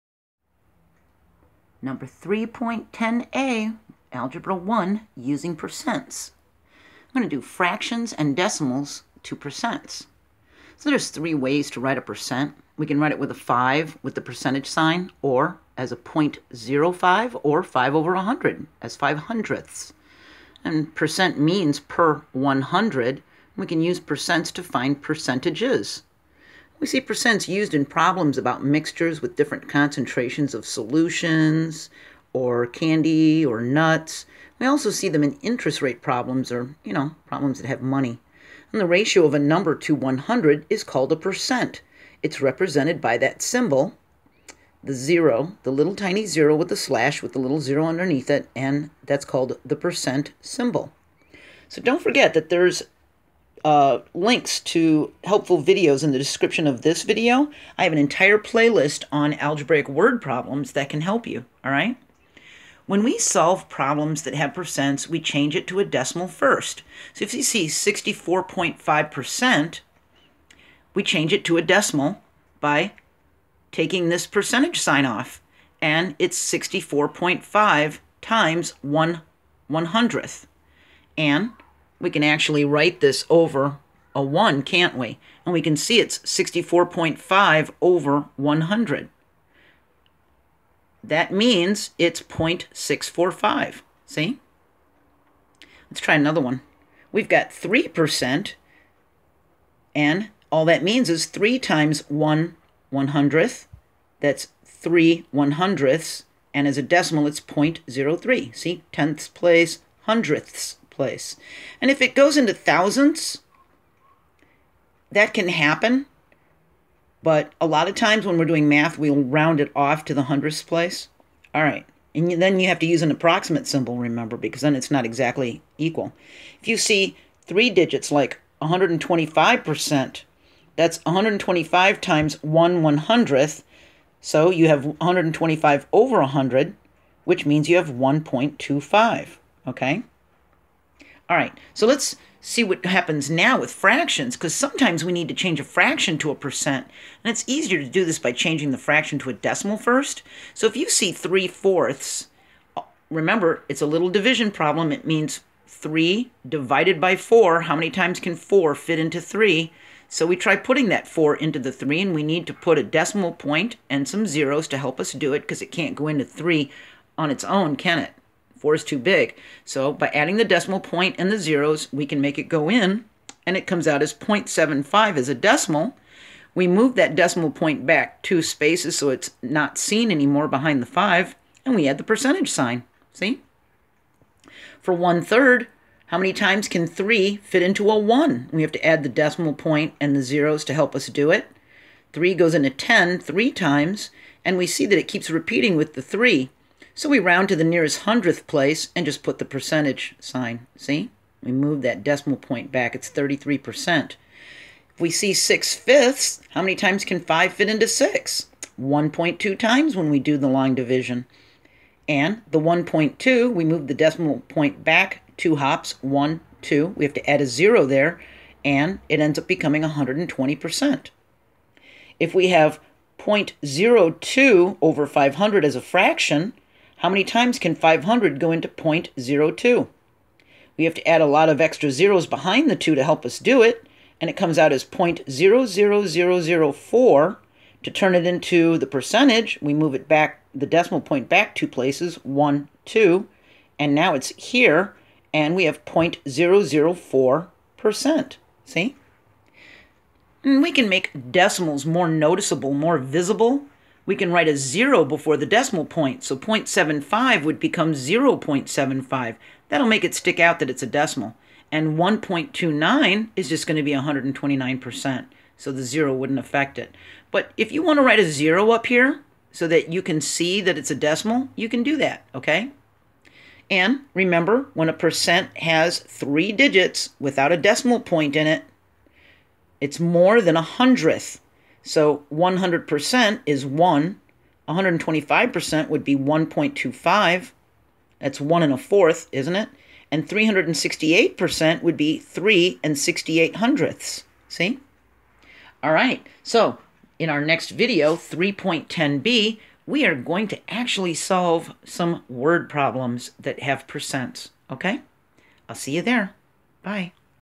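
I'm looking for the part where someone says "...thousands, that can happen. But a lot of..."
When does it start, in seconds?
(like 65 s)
112 s.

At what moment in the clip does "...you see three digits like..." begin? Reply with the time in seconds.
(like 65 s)
126 s.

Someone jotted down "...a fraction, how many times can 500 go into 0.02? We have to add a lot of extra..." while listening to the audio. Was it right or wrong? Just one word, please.
right.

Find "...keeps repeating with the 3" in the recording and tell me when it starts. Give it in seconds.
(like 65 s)
195 s.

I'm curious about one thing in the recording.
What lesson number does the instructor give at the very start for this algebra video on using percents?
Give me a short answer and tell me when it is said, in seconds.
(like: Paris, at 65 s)
3.10a, at 2 s.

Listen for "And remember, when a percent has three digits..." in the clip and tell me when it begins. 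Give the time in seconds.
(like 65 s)
273 s.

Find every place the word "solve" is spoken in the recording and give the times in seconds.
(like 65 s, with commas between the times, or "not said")
63 s, 301 s.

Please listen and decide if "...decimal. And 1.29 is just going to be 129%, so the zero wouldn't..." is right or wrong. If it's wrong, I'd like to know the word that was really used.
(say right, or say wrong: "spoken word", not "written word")
right.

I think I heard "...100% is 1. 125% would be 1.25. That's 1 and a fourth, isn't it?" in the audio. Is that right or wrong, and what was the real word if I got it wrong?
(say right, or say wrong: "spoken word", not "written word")
right.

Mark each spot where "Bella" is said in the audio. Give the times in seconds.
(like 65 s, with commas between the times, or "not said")
not said.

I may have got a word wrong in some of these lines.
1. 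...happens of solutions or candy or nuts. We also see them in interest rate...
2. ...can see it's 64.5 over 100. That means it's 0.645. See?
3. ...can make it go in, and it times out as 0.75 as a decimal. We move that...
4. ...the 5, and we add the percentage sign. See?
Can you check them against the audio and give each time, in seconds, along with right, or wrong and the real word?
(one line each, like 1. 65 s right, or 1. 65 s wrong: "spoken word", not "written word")
1. 29 s wrong: "concentrations", not "happens"
2. 85 s right
3. 172 s wrong: "comes", not "times"
4. 180 s right.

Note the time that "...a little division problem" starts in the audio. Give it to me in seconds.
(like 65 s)
153 s.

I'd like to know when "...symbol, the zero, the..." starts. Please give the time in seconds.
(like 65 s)
43 s.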